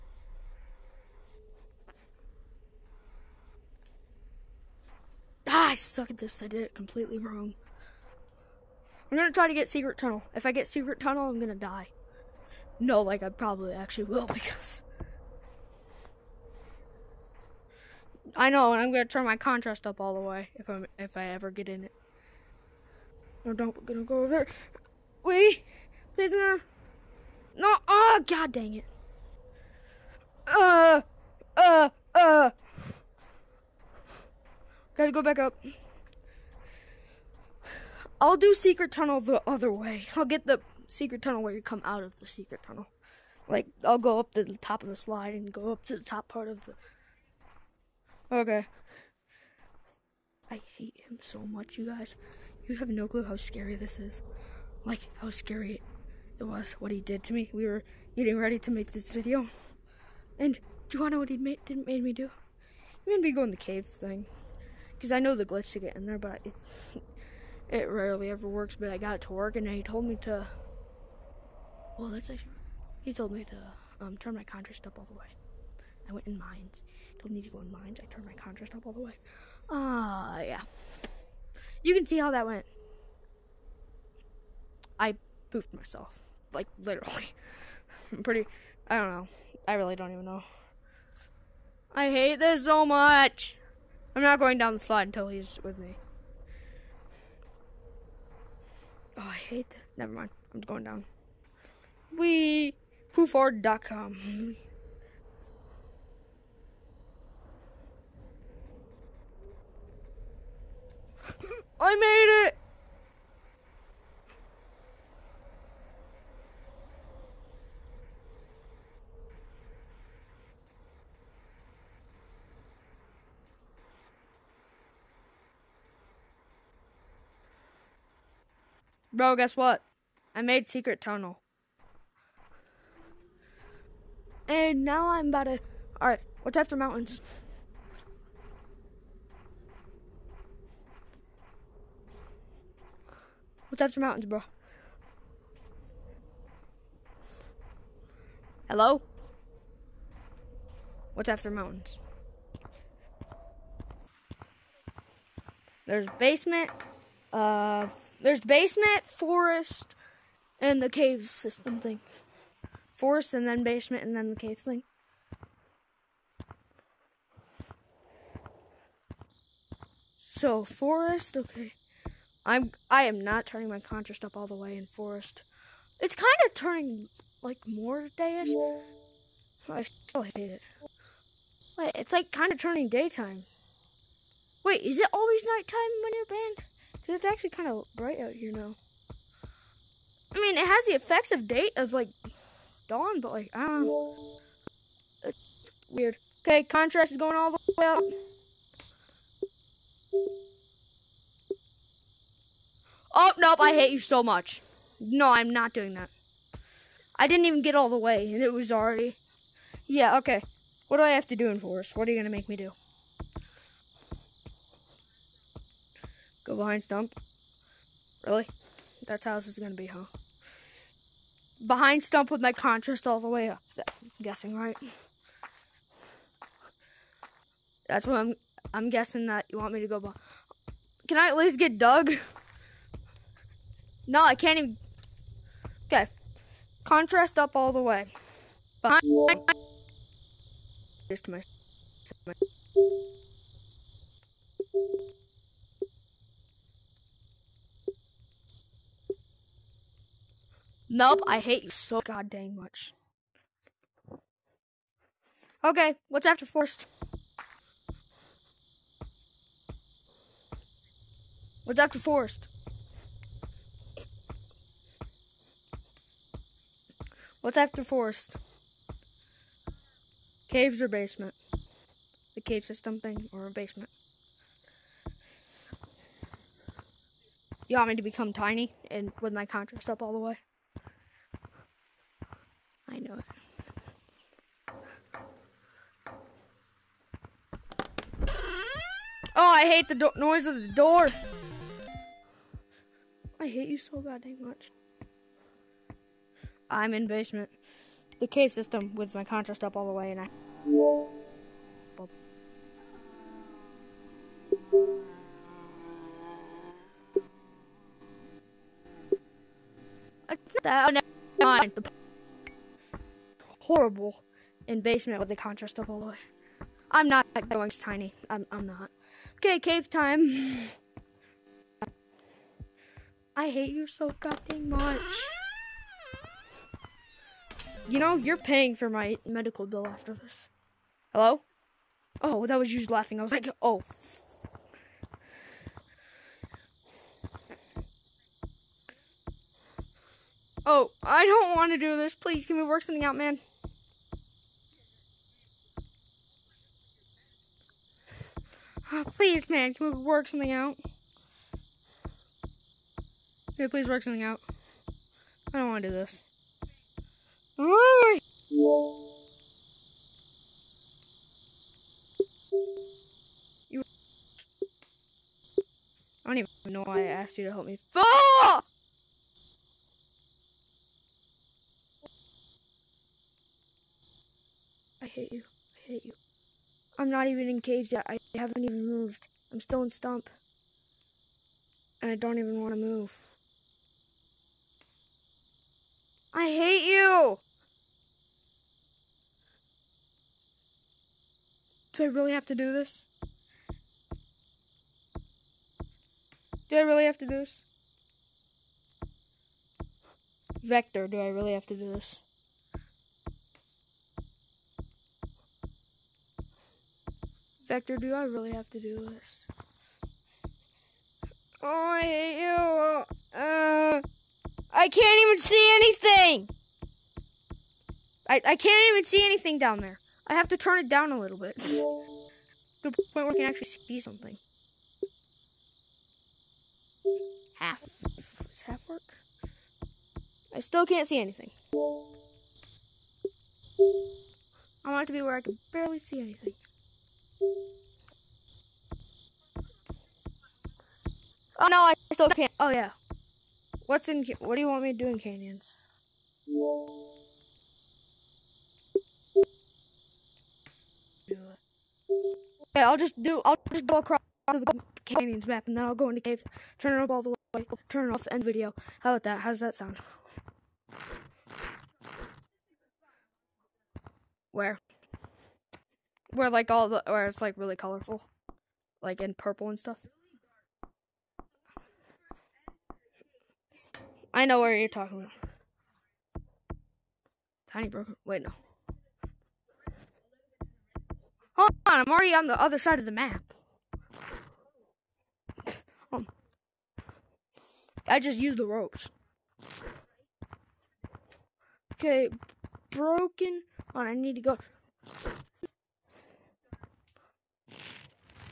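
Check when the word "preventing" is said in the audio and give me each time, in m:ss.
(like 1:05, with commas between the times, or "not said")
not said.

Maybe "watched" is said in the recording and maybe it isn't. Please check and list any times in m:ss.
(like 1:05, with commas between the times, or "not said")
not said.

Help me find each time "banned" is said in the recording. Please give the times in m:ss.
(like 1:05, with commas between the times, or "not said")
3:06.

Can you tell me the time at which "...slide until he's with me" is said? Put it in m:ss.
1:34.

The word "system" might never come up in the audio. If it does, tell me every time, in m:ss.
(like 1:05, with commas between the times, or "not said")
2:41, 4:32, 4:58.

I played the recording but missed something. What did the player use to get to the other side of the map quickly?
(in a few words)
the ropes.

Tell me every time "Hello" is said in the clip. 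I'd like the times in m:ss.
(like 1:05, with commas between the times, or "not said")
2:28, 5:31.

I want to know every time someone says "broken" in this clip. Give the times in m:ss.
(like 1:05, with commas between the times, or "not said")
7:57, 8:12.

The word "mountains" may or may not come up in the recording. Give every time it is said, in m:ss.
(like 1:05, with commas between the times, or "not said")
2:16, 2:23, 2:31.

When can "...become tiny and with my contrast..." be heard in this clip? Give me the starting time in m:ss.
4:38.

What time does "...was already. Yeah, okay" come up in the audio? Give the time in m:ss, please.
3:28.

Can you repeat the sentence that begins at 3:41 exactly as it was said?
Behind stump with my contrast all the way up.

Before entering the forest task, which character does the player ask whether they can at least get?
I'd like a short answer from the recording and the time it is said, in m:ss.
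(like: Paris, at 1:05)
Doug, at 3:51.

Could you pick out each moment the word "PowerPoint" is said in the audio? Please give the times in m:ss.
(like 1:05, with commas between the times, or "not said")
not said.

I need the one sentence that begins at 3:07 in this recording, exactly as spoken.
Cause it's actually kind of bright out here now.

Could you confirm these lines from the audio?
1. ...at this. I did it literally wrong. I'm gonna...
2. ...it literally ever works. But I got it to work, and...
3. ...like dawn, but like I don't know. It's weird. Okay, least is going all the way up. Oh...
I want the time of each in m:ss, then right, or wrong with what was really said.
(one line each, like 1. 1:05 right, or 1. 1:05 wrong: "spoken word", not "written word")
1. 0:06 wrong: "completely", not "literally"
2. 1:07 wrong: "rarely", not "literally"
3. 3:11 wrong: "contrast", not "least".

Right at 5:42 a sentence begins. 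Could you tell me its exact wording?
Please, can we work something out, man?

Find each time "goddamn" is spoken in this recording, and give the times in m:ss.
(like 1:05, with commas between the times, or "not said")
4:54, 5:24.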